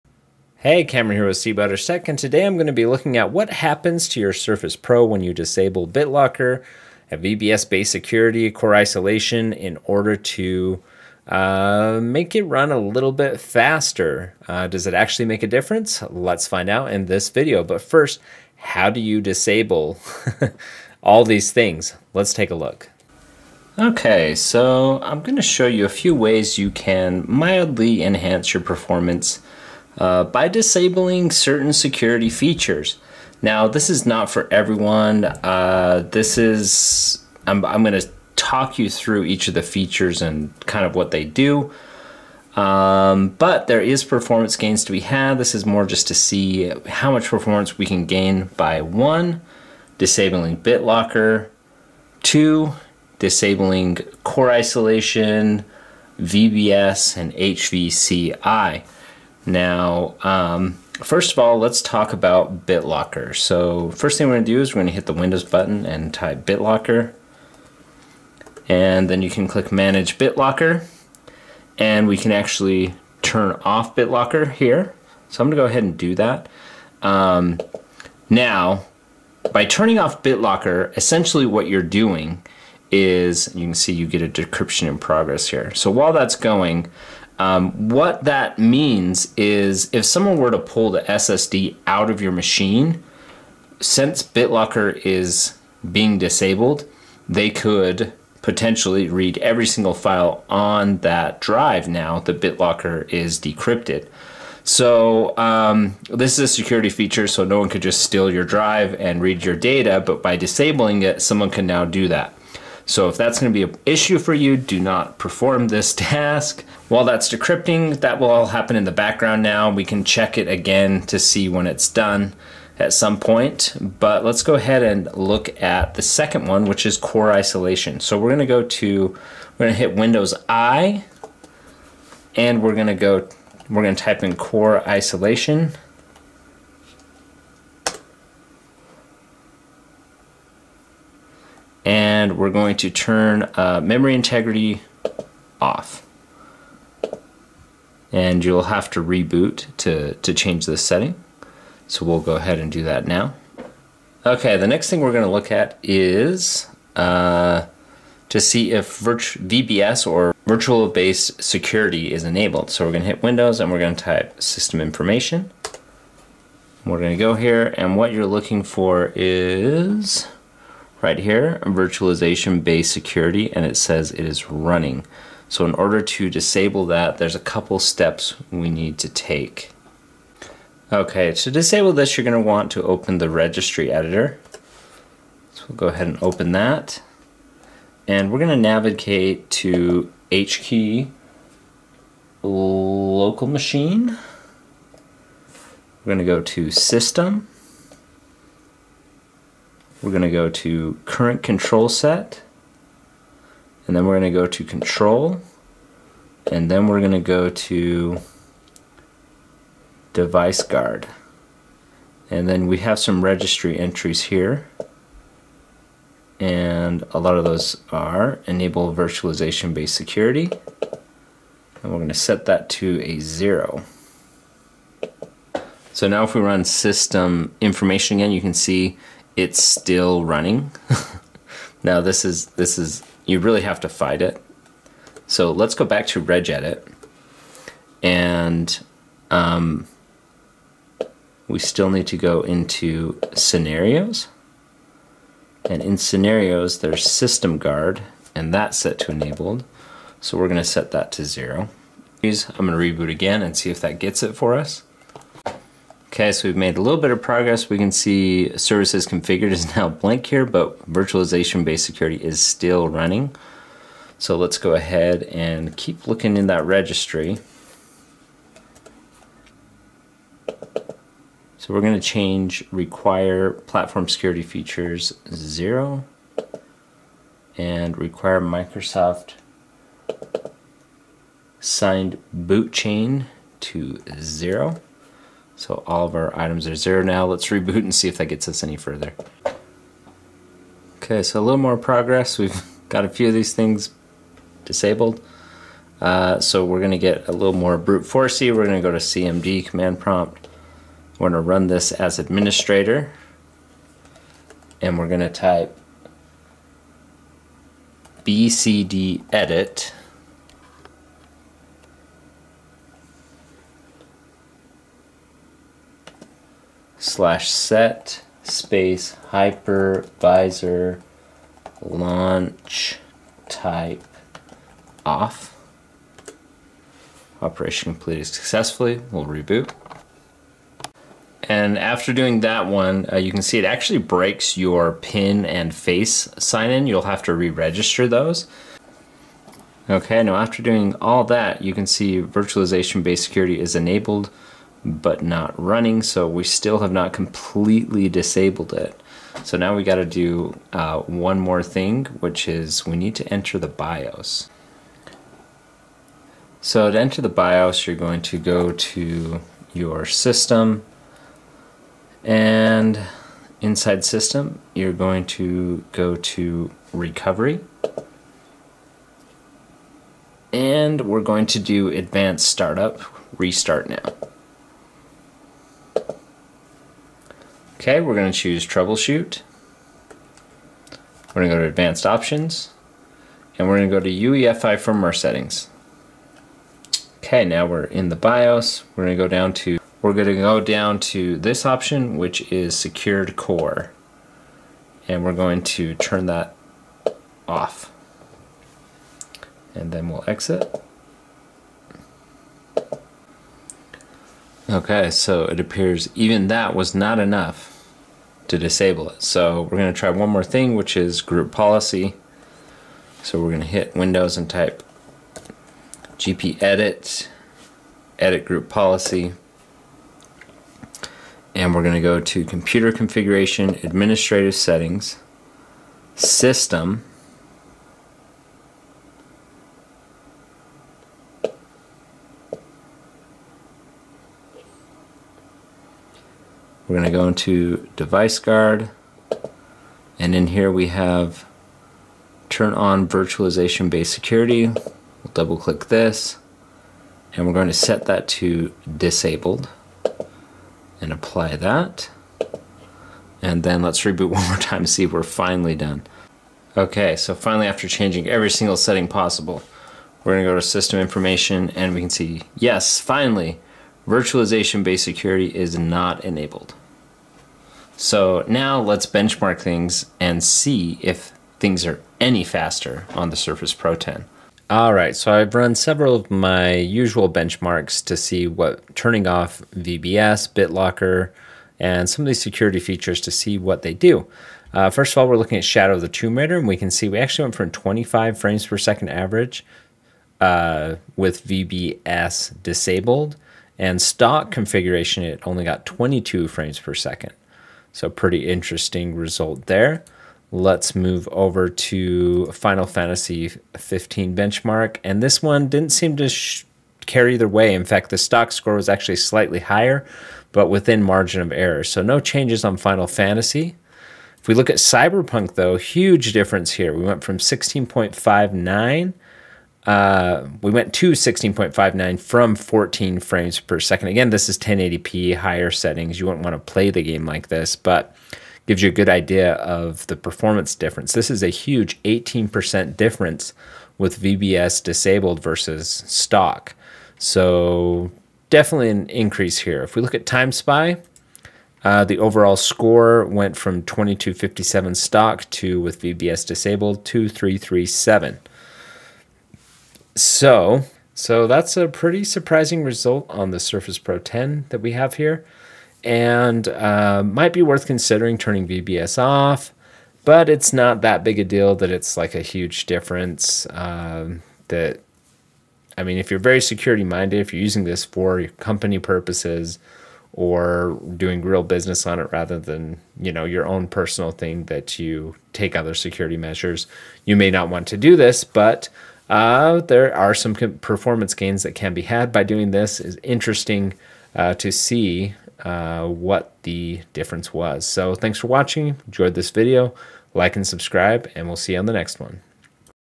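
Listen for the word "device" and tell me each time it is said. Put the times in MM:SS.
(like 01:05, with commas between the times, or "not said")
03:30, 07:17.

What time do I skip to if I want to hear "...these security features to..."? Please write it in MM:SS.
08:02.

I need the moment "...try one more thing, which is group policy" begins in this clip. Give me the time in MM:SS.
06:49.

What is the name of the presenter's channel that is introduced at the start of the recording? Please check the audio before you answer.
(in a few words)
cbutters Tech.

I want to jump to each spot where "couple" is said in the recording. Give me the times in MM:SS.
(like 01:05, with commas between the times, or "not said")
02:57.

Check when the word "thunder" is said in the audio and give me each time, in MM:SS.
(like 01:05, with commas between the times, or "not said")
not said.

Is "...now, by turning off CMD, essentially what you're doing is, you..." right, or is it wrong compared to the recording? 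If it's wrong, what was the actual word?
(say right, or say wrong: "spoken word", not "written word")
wrong: "BitLocker", not "CMD".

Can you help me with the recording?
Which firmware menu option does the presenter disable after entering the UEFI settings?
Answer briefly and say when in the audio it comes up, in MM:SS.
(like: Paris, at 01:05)
Secured Core, at 06:32.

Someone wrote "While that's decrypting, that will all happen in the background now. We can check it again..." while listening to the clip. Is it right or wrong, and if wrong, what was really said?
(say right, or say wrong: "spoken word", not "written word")
right.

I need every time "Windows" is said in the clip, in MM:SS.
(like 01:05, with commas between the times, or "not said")
01:05, 02:09, 02:43, 06:53.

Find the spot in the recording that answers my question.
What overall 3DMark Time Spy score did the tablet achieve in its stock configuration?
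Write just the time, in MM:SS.
09:03.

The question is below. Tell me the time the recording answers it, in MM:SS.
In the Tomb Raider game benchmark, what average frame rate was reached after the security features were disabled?
08:07.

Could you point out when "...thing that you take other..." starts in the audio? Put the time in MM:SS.
09:34.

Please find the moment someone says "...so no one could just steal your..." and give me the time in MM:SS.
01:47.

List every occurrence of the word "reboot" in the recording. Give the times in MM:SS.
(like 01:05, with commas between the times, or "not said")
02:29, 04:12, 04:47, 05:29, 07:34.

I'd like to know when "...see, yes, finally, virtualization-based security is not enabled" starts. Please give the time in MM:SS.
07:42.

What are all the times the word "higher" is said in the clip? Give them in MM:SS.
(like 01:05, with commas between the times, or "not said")
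08:29, 08:45.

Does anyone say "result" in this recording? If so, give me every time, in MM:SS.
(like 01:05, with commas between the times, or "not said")
08:19, 09:12.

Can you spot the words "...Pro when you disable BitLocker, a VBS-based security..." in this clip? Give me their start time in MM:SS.
00:04.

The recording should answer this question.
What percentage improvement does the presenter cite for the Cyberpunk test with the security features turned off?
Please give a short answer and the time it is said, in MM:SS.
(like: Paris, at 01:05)
18%, at 08:52.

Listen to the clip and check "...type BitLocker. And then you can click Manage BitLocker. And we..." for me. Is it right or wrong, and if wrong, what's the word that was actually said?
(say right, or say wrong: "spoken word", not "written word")
right.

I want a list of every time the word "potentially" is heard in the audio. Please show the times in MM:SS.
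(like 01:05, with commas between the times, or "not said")
01:38.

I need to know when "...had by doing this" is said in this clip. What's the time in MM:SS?
09:42.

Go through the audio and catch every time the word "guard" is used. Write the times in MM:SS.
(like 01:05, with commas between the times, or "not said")
03:30, 04:07, 07:18.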